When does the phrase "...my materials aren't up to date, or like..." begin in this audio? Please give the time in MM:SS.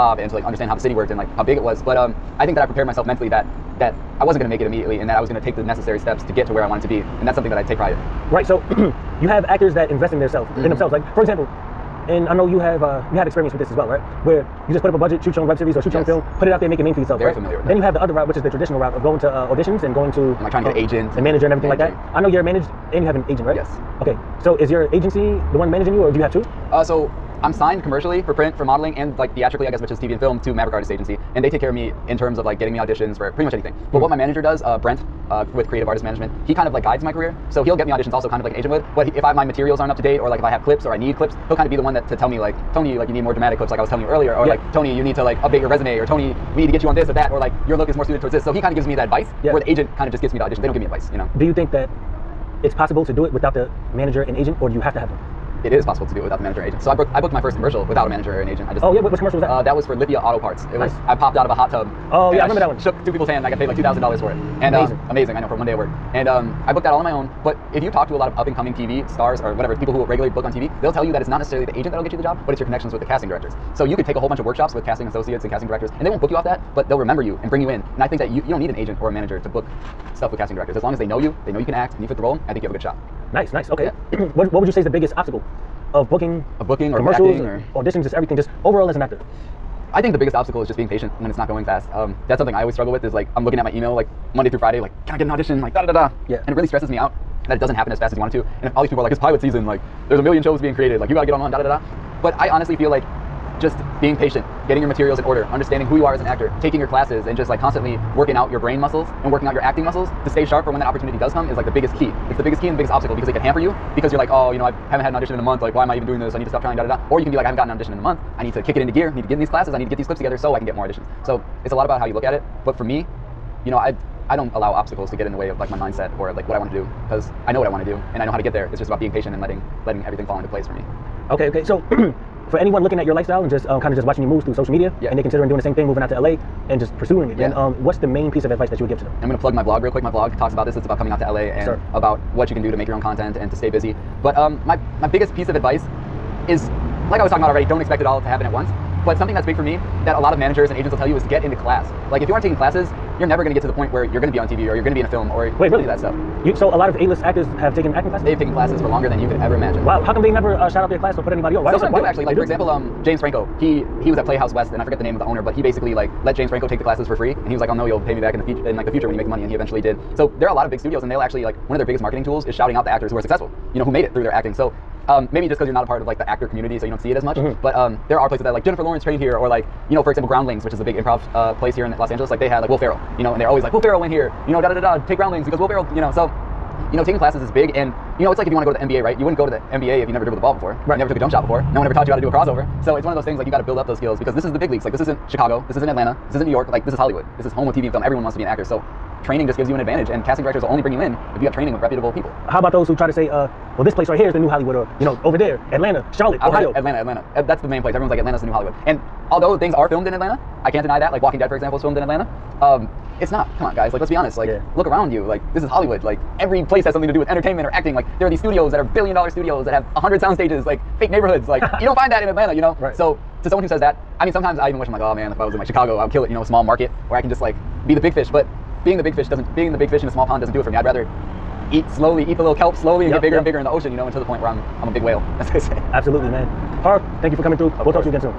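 00:39.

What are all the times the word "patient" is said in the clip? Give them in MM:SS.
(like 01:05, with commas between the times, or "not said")
01:30, 01:44, 02:09.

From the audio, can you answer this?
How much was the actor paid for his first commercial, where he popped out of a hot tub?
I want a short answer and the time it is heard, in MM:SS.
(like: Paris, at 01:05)
$2,000, at 01:03.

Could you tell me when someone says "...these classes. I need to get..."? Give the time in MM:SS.
01:59.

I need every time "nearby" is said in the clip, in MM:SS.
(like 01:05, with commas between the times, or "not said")
not said.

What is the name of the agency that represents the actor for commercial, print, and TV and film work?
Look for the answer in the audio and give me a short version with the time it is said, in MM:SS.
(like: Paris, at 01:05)
Maverick Artist Agency, at 00:30.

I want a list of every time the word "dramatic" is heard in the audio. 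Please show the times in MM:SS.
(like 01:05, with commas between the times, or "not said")
00:43.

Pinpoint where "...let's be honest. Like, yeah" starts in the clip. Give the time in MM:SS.
03:34.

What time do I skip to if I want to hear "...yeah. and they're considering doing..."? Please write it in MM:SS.
02:15.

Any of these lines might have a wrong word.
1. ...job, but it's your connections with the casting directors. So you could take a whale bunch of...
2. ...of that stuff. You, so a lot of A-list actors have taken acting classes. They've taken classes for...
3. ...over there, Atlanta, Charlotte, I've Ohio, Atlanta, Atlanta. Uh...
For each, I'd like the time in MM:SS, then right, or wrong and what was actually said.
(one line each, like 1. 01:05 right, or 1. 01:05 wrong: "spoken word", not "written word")
1. 01:12 wrong: "whole", not "whale"
2. 02:35 right
3. 03:25 right.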